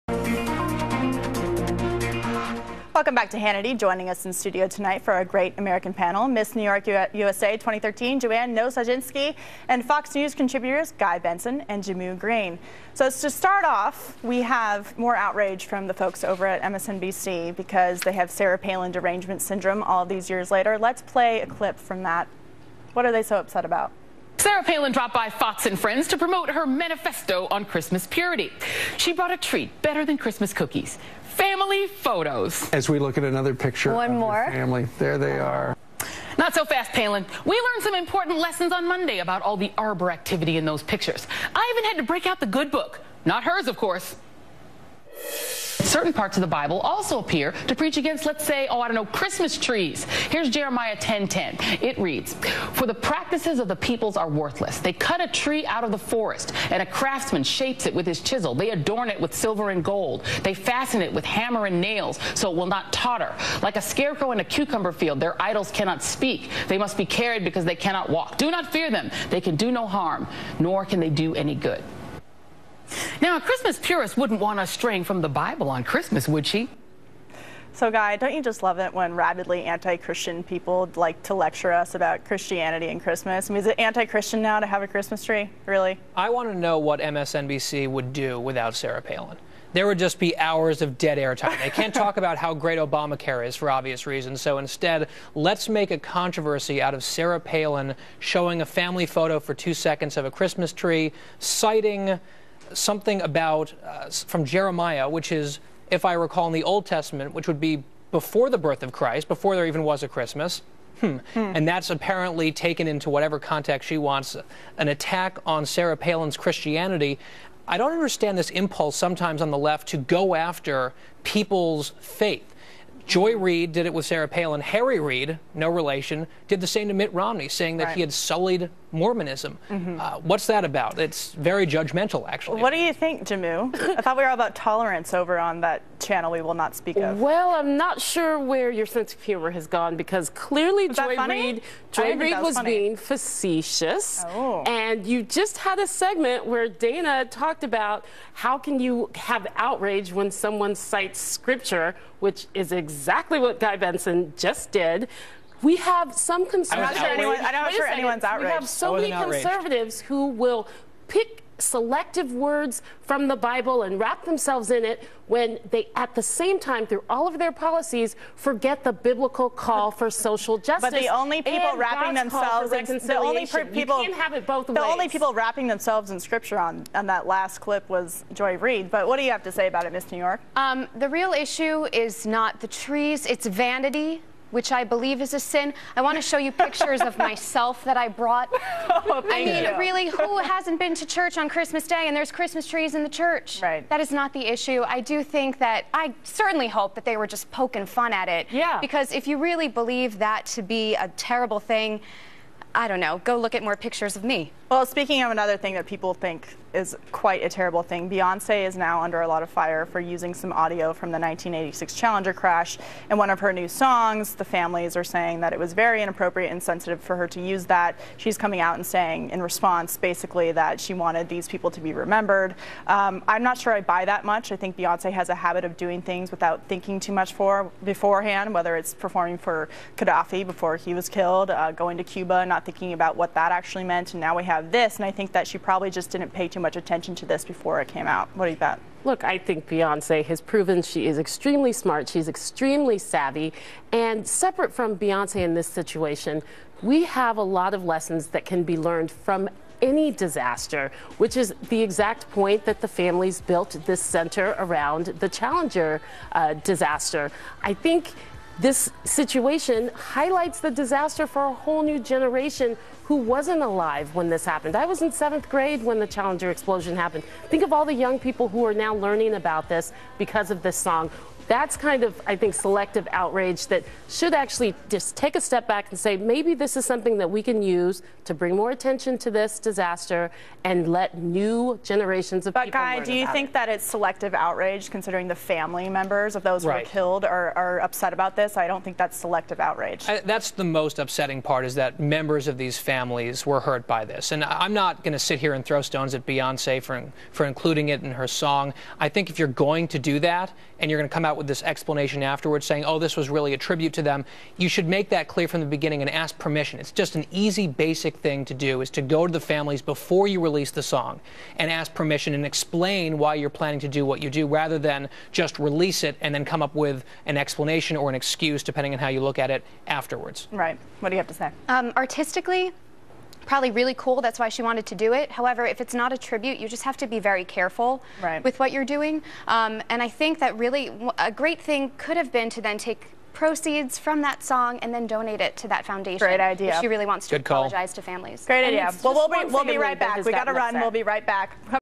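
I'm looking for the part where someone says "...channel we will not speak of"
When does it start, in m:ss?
2:15.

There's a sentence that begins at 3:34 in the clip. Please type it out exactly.
The families are saying that it was very inappropriate and sensitive for her to use that.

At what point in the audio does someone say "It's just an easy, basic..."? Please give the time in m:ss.
5:06.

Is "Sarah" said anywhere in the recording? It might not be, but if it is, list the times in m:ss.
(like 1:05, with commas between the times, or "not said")
0:18, 0:24, 1:28, 1:37, 1:55, 2:04.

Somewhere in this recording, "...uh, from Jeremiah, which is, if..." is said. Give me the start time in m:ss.
1:43.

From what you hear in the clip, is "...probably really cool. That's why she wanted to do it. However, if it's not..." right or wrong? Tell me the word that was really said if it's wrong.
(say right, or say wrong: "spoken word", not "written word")
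right.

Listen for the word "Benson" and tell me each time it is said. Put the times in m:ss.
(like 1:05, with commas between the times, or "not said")
0:11, 2:33.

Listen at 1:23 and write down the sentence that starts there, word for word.
I mean, is it anti-Christian now to have a Christmas tree?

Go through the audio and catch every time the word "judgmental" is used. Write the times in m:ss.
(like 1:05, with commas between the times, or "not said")
2:11.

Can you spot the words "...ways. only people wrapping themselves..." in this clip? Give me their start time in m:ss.
2:54.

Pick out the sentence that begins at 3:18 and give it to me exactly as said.
Because if you really believe that to be a terrible thing, I don't know, go look at more pictures of me.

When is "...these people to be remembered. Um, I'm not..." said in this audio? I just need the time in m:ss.
3:41.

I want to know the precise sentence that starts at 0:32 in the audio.
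As we look at another picture One more.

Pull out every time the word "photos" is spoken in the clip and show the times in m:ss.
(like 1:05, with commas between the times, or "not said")
0:31, 1:39.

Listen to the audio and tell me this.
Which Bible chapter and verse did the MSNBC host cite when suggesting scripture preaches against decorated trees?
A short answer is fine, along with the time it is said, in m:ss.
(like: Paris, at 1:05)
Jeremiah 10.10, at 0:50.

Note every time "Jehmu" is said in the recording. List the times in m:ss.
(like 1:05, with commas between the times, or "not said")
0:11, 2:13.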